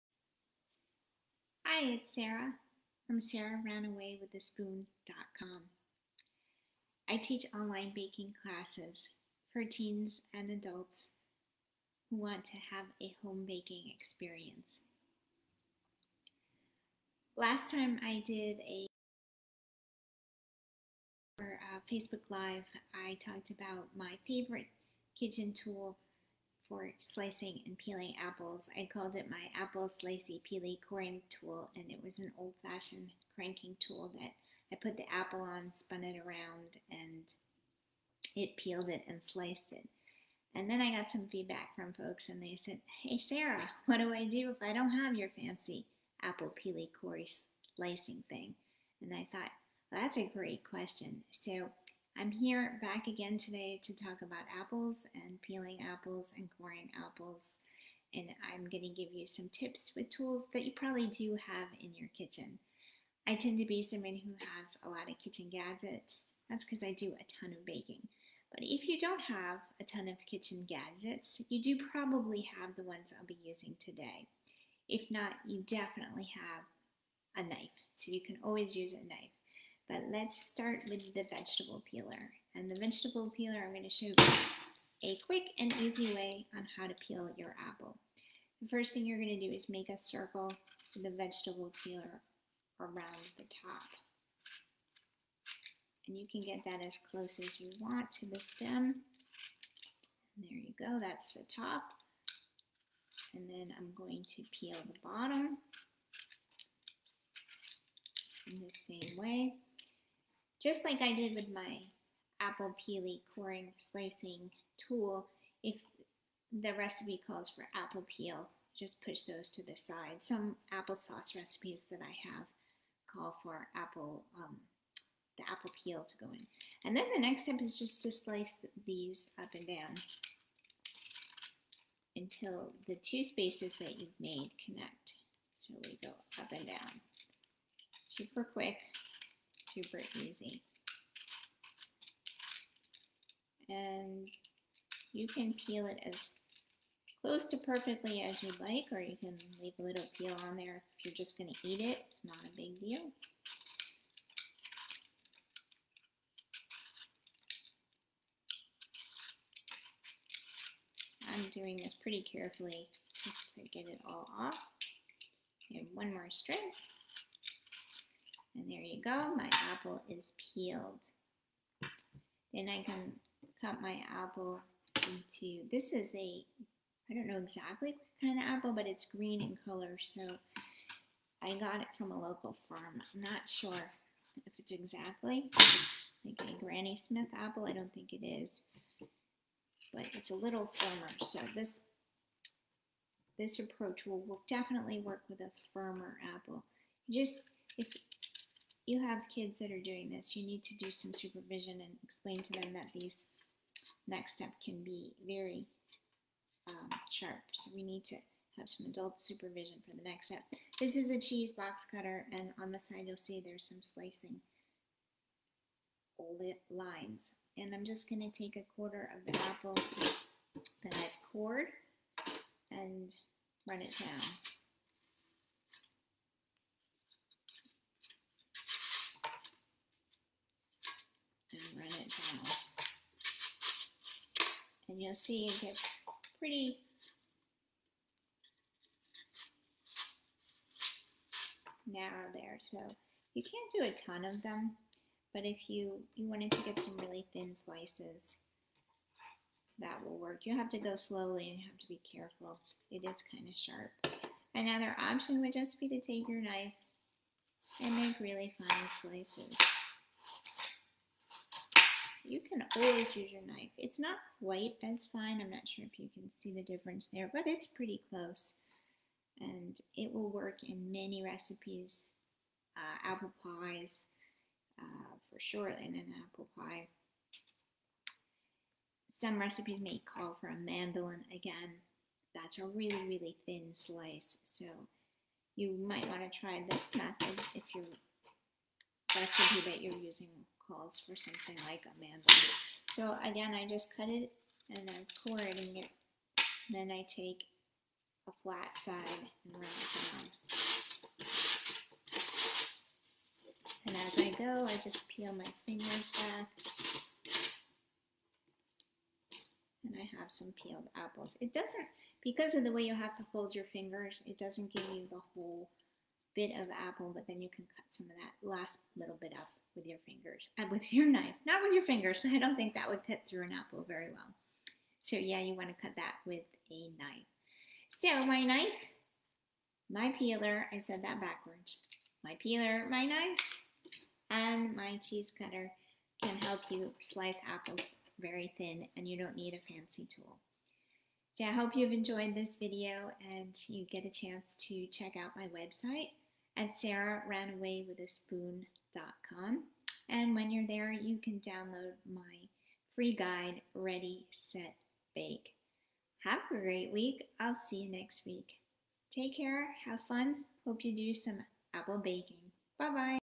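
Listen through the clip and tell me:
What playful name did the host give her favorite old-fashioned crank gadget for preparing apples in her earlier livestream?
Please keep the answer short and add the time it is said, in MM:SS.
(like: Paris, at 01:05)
apple slicey peely coring tool, at 00:29.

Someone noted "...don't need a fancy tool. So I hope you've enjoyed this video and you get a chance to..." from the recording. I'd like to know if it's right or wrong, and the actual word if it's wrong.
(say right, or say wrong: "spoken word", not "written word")
right.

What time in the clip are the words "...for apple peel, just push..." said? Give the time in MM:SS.
01:57.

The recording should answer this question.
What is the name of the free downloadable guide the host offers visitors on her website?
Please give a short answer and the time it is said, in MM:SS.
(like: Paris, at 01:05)
Ready, Set, Bake, at 05:53.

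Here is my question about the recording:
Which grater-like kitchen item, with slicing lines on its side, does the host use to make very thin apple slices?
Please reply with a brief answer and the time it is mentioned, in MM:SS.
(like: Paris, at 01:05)
cheese box cutter, at 03:31.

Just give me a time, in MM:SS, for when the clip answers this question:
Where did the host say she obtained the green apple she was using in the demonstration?
03:02.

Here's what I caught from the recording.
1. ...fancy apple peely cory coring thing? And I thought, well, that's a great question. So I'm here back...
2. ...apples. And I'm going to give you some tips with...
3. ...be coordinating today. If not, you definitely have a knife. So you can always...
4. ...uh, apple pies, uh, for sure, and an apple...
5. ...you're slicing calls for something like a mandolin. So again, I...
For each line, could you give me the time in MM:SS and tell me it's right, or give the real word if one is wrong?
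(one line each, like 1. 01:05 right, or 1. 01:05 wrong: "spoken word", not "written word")
1. 00:45 wrong: "slicing", not "coring"
2. 00:56 right
3. 01:13 wrong: "using", not "coordinating"
4. 04:32 right
5. 04:49 wrong: "using", not "slicing".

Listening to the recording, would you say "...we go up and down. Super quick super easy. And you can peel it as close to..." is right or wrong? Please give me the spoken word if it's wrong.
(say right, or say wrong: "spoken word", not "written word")
right.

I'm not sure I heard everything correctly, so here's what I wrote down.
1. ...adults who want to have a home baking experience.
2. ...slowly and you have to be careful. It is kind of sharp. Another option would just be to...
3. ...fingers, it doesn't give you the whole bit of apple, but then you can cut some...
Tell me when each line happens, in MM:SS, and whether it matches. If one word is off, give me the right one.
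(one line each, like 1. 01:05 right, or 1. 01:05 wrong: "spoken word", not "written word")
1. 00:10 right
2. 04:10 right
3. 05:13 right.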